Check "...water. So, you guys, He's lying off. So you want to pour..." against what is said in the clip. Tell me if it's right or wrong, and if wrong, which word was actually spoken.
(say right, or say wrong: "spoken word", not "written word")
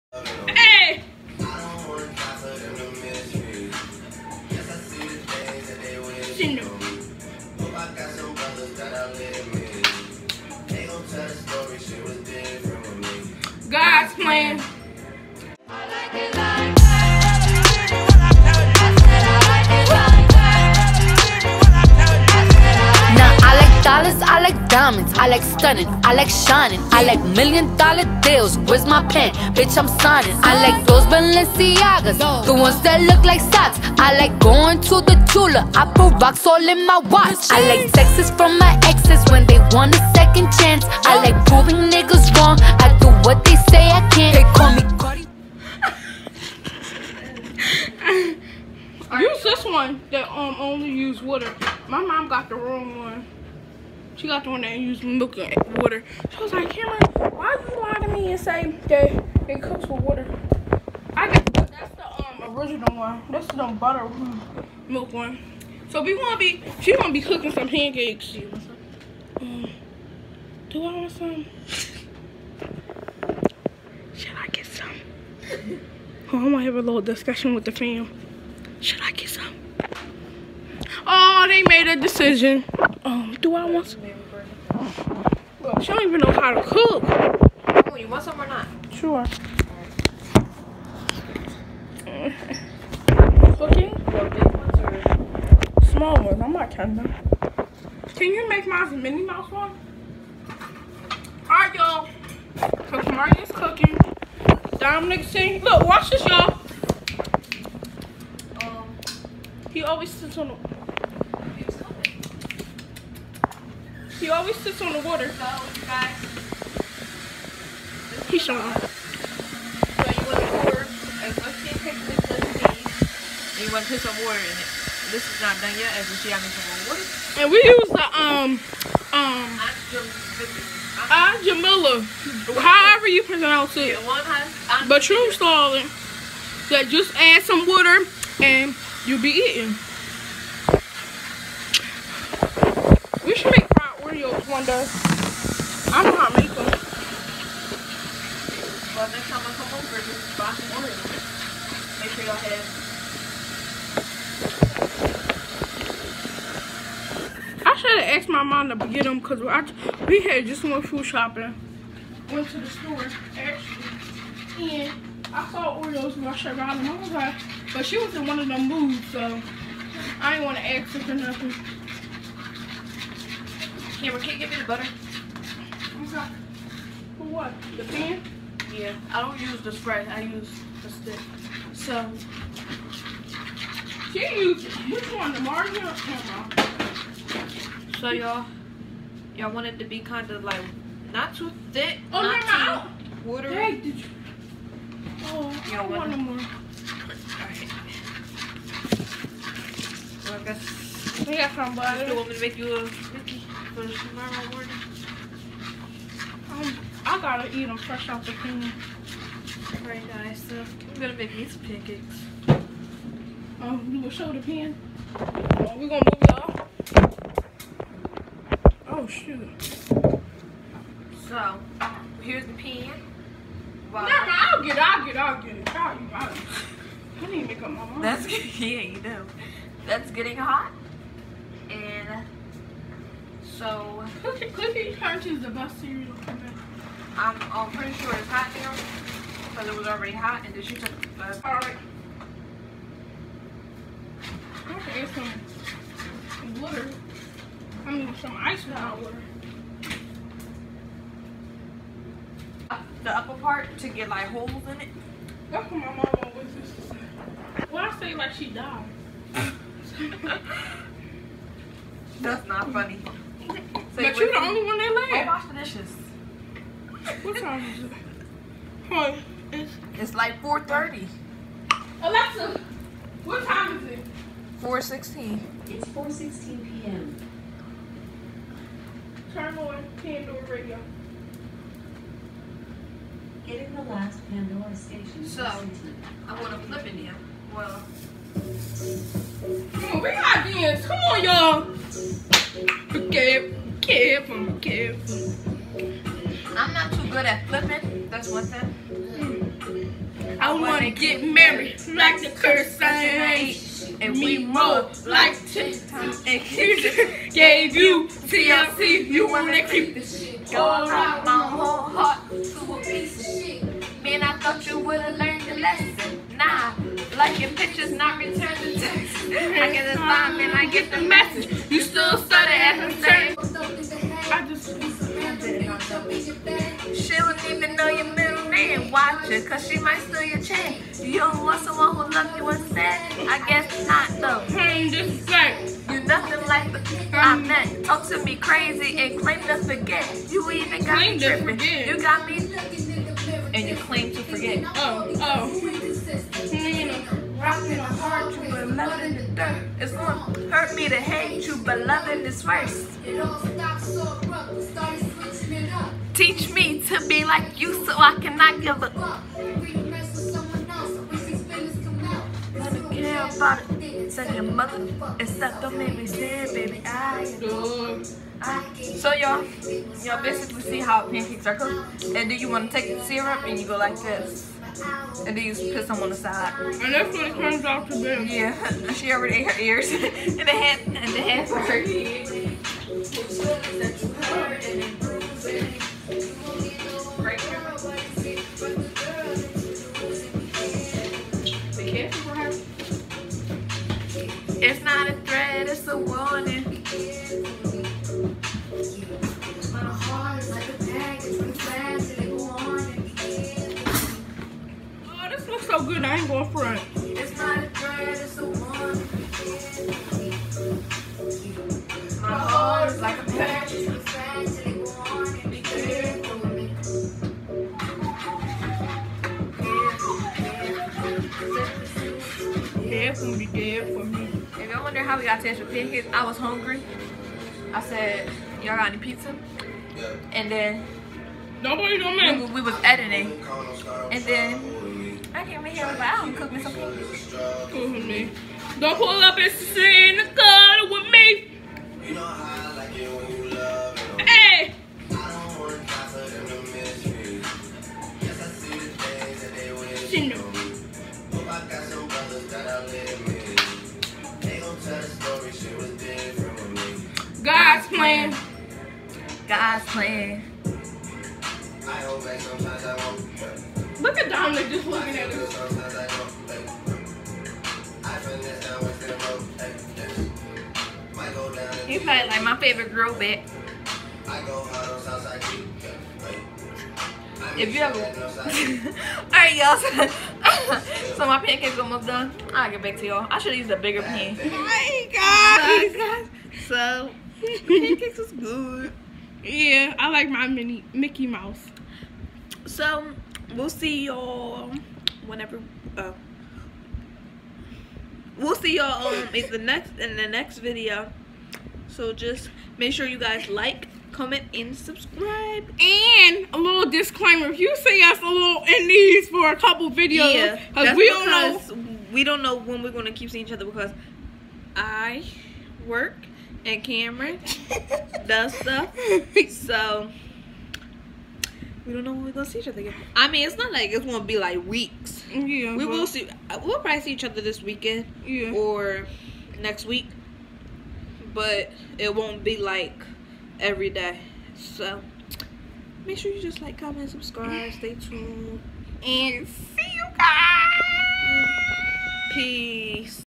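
wrong: "showing", not "lying".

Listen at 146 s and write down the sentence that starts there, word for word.
Well, next time I come over, just buy some orange.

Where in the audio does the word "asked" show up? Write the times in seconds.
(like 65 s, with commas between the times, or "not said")
158 s.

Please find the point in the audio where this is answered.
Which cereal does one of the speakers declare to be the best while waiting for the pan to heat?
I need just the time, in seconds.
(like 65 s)
234 s.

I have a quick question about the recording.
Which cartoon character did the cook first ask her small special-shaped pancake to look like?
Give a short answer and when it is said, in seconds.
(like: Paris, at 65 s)
Minnie Mouse, at 98 s.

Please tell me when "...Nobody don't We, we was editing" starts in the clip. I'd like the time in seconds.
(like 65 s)
431 s.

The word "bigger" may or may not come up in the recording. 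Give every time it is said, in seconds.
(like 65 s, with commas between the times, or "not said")
483 s.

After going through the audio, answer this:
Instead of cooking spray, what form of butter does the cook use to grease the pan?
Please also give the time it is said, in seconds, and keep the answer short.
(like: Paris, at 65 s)
the stick, at 180 s.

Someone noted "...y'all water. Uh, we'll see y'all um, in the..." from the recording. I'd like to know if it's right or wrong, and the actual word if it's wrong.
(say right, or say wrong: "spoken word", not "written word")
wrong: "whenever", not "water".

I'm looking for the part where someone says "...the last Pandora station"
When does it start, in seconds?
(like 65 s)
283 s.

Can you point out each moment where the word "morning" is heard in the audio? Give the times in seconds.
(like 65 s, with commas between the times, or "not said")
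204 s.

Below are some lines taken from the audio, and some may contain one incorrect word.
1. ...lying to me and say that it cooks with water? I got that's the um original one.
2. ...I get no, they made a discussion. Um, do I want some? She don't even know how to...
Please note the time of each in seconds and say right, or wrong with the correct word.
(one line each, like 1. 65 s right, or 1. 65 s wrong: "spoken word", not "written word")
1. 57 s right
2. 79 s wrong: "decision", not "discussion".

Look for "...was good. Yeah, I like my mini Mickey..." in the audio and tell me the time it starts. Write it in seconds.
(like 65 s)
488 s.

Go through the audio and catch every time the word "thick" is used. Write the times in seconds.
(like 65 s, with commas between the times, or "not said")
191 s.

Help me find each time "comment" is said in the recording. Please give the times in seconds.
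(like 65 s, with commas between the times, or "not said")
504 s, 536 s.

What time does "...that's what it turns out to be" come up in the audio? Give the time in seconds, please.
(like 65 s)
376 s.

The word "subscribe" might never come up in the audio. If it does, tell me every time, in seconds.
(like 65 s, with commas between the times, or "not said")
504 s, 537 s.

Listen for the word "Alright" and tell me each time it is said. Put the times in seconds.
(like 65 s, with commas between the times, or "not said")
101 s, 209 s, 241 s.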